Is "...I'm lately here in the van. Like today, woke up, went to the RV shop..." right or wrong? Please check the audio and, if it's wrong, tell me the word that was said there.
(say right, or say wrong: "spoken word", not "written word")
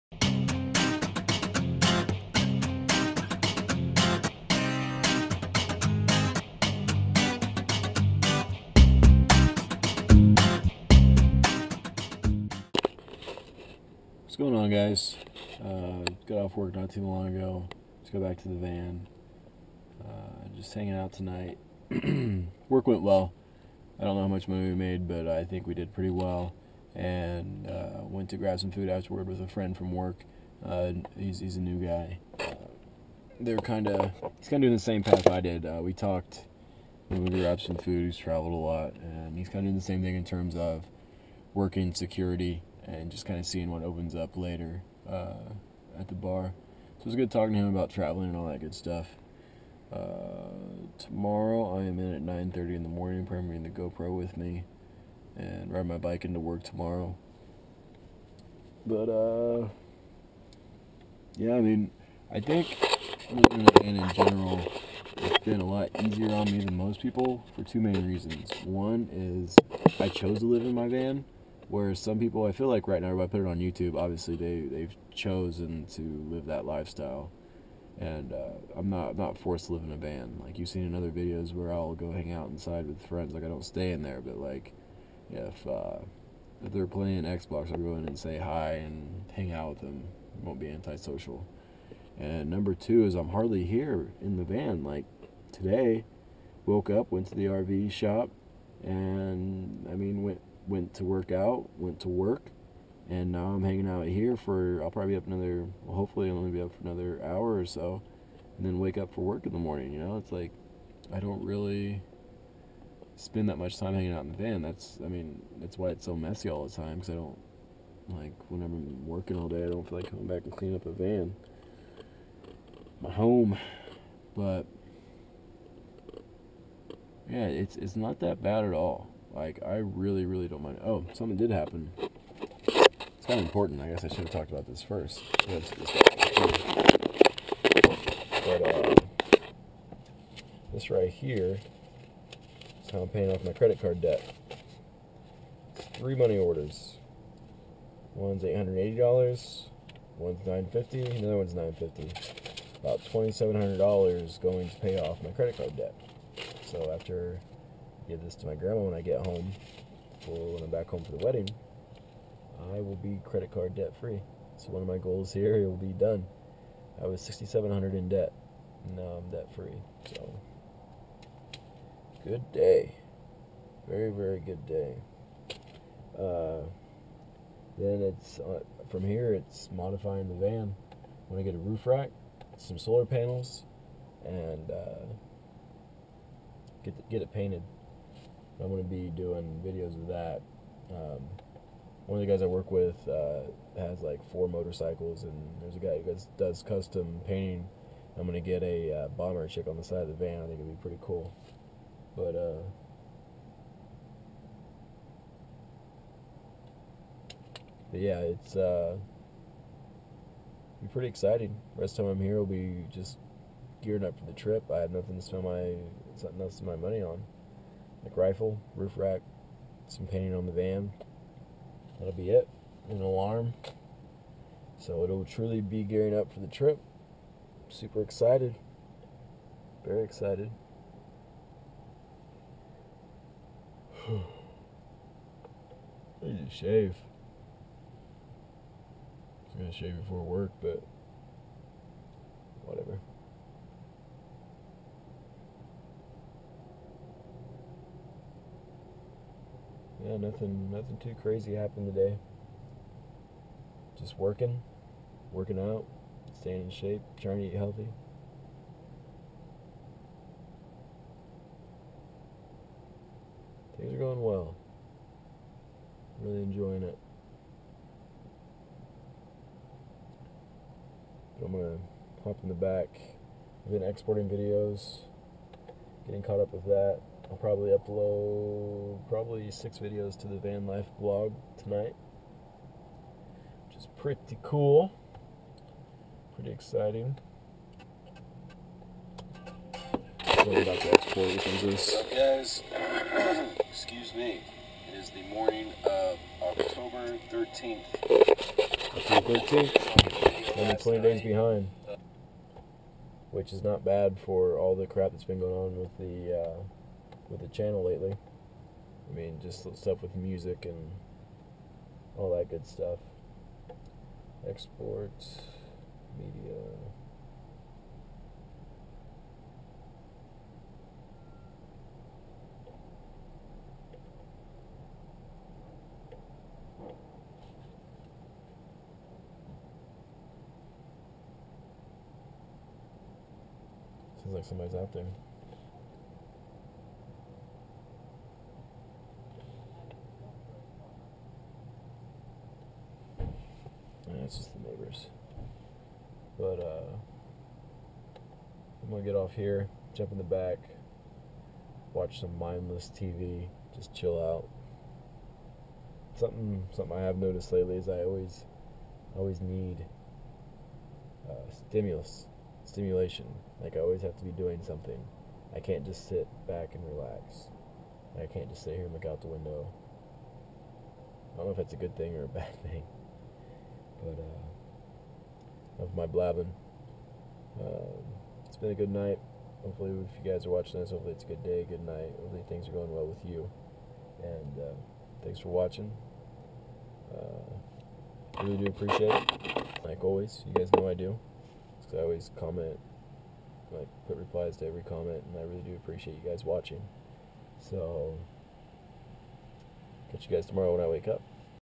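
wrong: "hardly", not "lately".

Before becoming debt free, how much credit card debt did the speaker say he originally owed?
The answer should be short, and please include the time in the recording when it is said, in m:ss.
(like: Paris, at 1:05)
6,700, at 2:47.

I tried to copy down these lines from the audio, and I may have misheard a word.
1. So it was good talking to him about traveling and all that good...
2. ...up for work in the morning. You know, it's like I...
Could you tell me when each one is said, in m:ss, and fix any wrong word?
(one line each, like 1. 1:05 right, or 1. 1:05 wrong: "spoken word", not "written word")
1. 0:46 right
2. 1:48 right.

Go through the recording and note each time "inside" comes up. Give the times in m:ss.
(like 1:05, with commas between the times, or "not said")
1:22.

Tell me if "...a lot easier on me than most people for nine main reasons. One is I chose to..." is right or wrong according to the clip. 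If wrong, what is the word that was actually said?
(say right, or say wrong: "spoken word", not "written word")
wrong: "two", not "nine".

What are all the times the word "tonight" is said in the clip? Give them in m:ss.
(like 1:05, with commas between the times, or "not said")
0:21, 4:41.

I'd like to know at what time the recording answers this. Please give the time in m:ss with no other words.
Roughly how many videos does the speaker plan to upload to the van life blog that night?
4:39.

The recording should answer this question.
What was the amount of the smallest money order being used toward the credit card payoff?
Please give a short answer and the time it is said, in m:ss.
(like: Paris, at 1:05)
$880, at 2:28.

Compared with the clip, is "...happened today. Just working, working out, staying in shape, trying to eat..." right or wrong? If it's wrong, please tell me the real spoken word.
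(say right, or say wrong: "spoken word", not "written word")
right.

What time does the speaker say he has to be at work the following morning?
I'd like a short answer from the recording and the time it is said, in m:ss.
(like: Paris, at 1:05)
9:30, at 0:52.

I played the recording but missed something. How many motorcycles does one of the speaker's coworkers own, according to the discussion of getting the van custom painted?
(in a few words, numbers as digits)
4.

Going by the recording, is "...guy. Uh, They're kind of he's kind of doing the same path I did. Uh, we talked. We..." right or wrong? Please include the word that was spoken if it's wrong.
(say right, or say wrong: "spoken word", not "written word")
right.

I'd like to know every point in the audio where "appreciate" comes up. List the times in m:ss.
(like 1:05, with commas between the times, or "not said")
6:28, 6:35.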